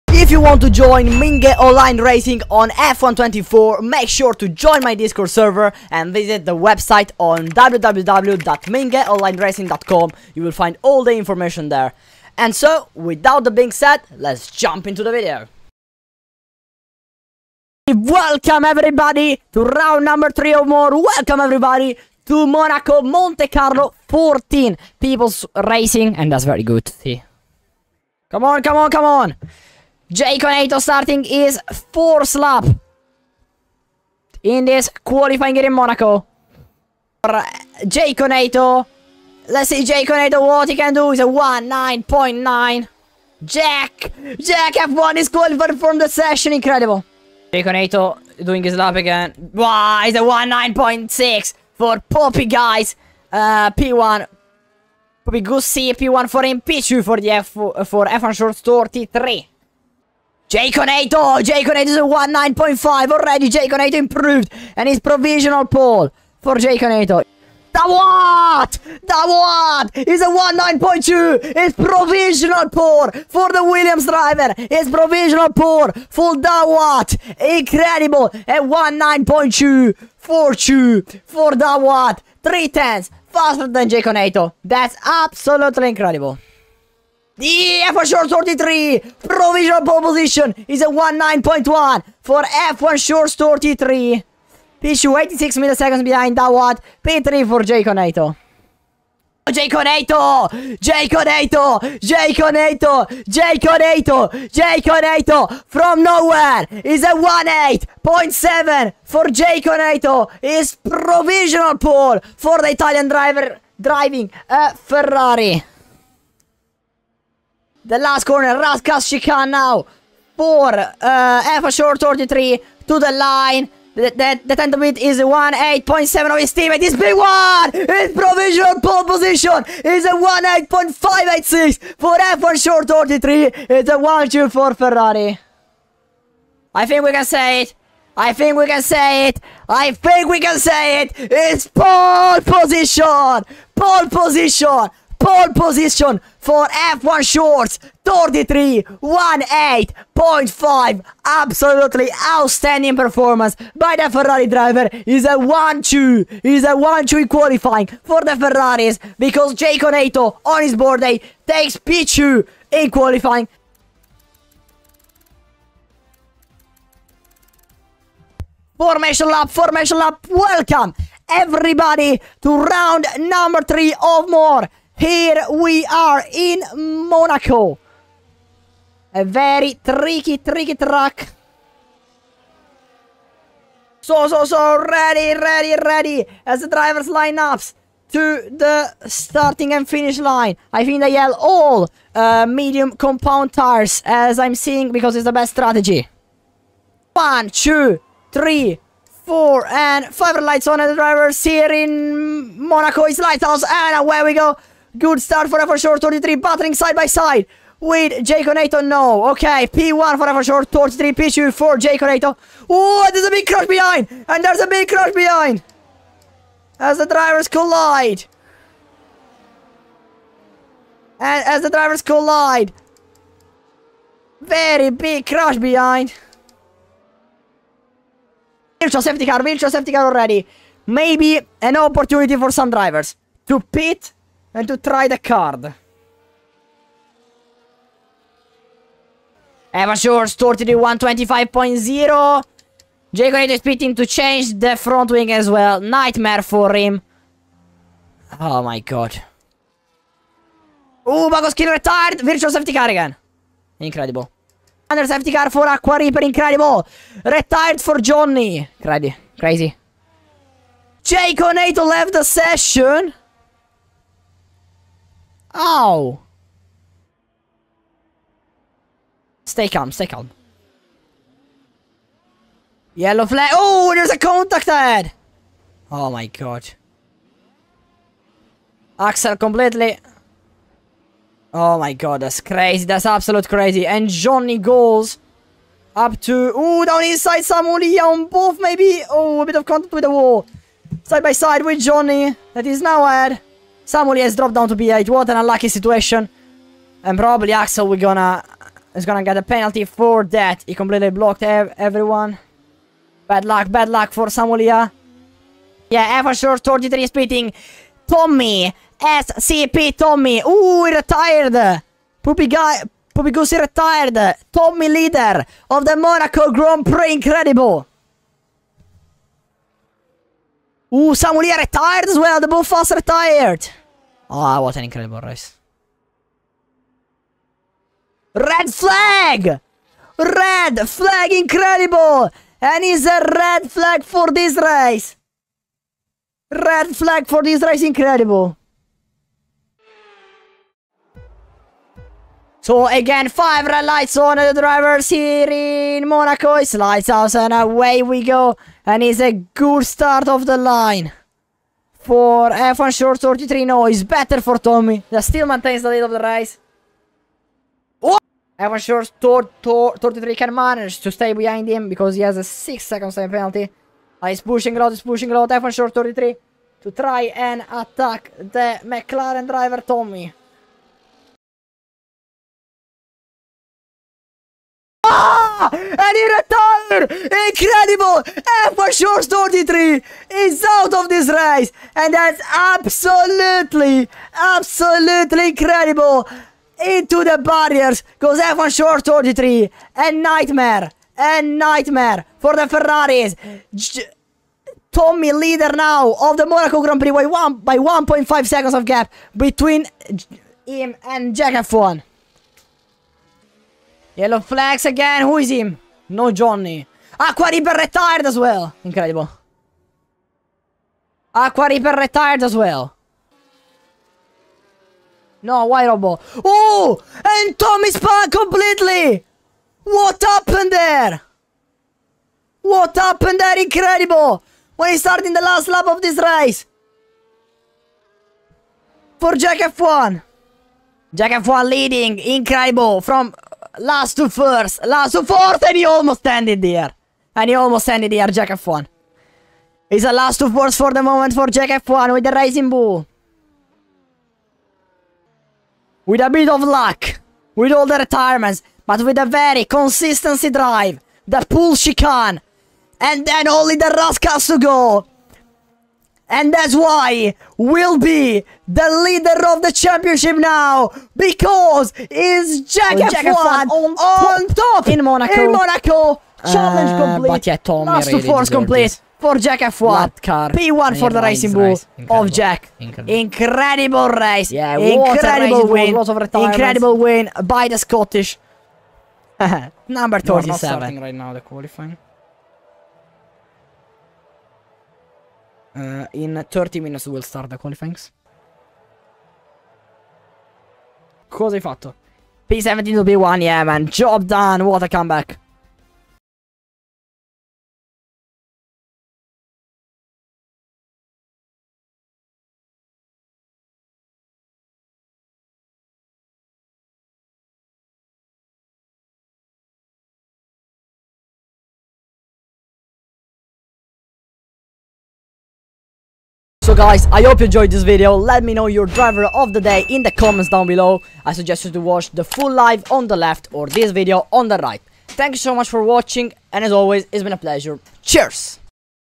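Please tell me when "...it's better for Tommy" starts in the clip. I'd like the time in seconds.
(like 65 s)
353 s.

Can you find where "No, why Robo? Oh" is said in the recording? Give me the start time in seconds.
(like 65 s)
415 s.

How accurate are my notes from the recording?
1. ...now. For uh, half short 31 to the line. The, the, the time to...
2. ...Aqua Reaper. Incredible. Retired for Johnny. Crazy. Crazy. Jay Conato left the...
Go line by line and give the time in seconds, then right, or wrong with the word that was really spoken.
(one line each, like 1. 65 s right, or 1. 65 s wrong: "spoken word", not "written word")
1. 119 s wrong: "33", not "31"
2. 255 s right.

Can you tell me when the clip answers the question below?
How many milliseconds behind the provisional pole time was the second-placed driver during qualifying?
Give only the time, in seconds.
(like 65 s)
95 s.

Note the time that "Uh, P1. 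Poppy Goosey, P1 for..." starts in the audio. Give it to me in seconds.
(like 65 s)
53 s.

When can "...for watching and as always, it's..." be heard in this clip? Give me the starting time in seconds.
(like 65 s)
525 s.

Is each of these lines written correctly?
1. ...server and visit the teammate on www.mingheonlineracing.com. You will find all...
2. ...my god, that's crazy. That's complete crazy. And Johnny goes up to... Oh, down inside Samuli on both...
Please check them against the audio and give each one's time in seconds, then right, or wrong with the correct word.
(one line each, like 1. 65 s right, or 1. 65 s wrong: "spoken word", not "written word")
1. 5 s wrong: "website", not "teammate"
2. 281 s wrong: "absolute", not "complete".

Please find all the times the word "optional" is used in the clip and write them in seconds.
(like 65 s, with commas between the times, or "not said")
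not said.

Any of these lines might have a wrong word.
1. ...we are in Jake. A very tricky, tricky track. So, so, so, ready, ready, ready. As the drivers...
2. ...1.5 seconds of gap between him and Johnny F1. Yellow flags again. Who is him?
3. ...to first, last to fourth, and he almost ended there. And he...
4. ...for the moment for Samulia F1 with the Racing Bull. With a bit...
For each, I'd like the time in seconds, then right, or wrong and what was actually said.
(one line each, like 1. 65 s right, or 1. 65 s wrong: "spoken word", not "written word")
1. 175 s wrong: "Monaco", not "Jake"
2. 397 s wrong: "Jack", not "Johnny"
3. 434 s right
4. 440 s wrong: "Jack", not "Samulia".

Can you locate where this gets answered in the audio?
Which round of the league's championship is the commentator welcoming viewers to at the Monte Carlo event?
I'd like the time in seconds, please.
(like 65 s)
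19 s.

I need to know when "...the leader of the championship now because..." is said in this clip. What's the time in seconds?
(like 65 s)
458 s.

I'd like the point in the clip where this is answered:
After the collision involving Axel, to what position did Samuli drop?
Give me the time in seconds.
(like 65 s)
294 s.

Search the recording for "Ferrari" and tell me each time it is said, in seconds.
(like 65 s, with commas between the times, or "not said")
114 s, 134 s, 154 s, 158 s, 392 s.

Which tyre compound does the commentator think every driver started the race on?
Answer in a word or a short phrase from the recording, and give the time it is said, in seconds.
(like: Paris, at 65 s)
Medium, at 192 s.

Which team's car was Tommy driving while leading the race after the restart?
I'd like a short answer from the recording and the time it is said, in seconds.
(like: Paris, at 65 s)
McLaren, at 368 s.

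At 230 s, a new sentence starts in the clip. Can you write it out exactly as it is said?
Maybe an opportunity for some drivers to pit and to try the card.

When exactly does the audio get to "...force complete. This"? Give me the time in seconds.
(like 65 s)
468 s.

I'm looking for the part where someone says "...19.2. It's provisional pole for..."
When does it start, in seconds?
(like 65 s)
70 s.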